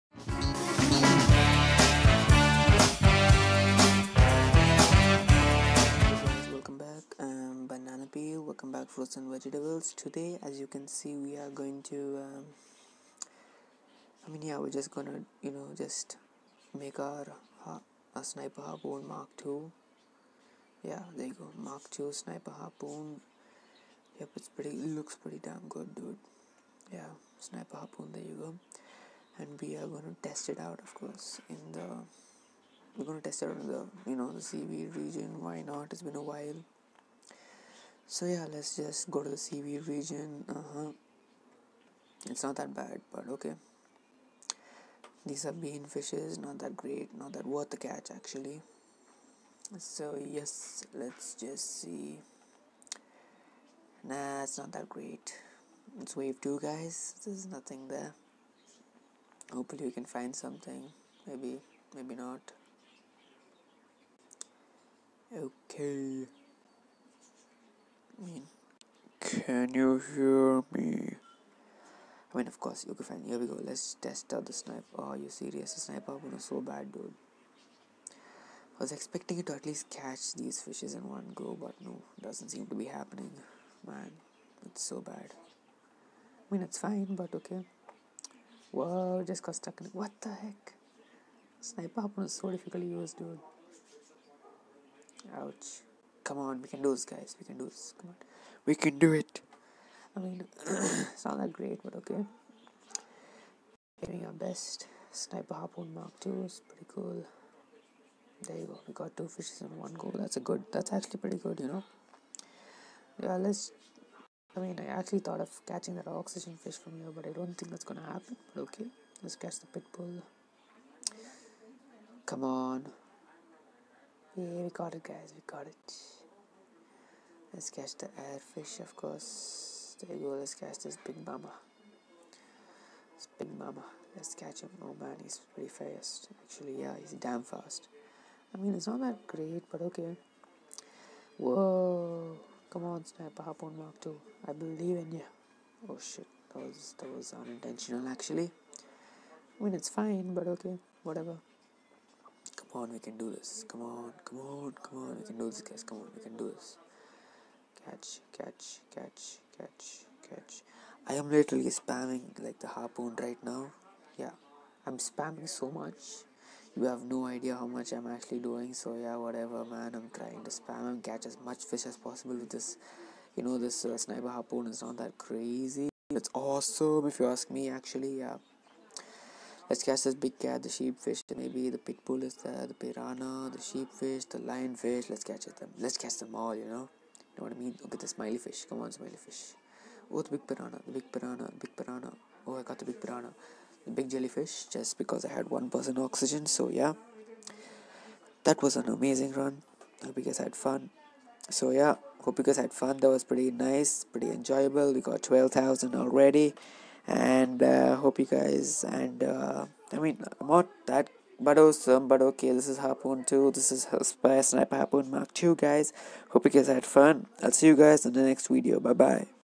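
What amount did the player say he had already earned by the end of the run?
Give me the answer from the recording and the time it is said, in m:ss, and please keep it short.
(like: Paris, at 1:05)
12,000, at 3:25.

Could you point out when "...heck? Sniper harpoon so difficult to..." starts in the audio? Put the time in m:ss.
1:30.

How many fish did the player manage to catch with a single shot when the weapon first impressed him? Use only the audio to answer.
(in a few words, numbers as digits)
2.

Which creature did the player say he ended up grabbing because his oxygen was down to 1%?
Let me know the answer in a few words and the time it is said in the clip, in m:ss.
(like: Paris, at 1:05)
big jellyfish, at 3:13.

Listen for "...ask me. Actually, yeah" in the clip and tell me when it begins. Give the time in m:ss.
2:57.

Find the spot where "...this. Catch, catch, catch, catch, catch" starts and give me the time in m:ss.
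2:36.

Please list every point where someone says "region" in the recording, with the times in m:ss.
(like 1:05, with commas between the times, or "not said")
0:34, 0:39.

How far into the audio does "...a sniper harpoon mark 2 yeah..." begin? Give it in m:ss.
0:18.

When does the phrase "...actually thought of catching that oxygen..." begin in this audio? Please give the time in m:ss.
1:54.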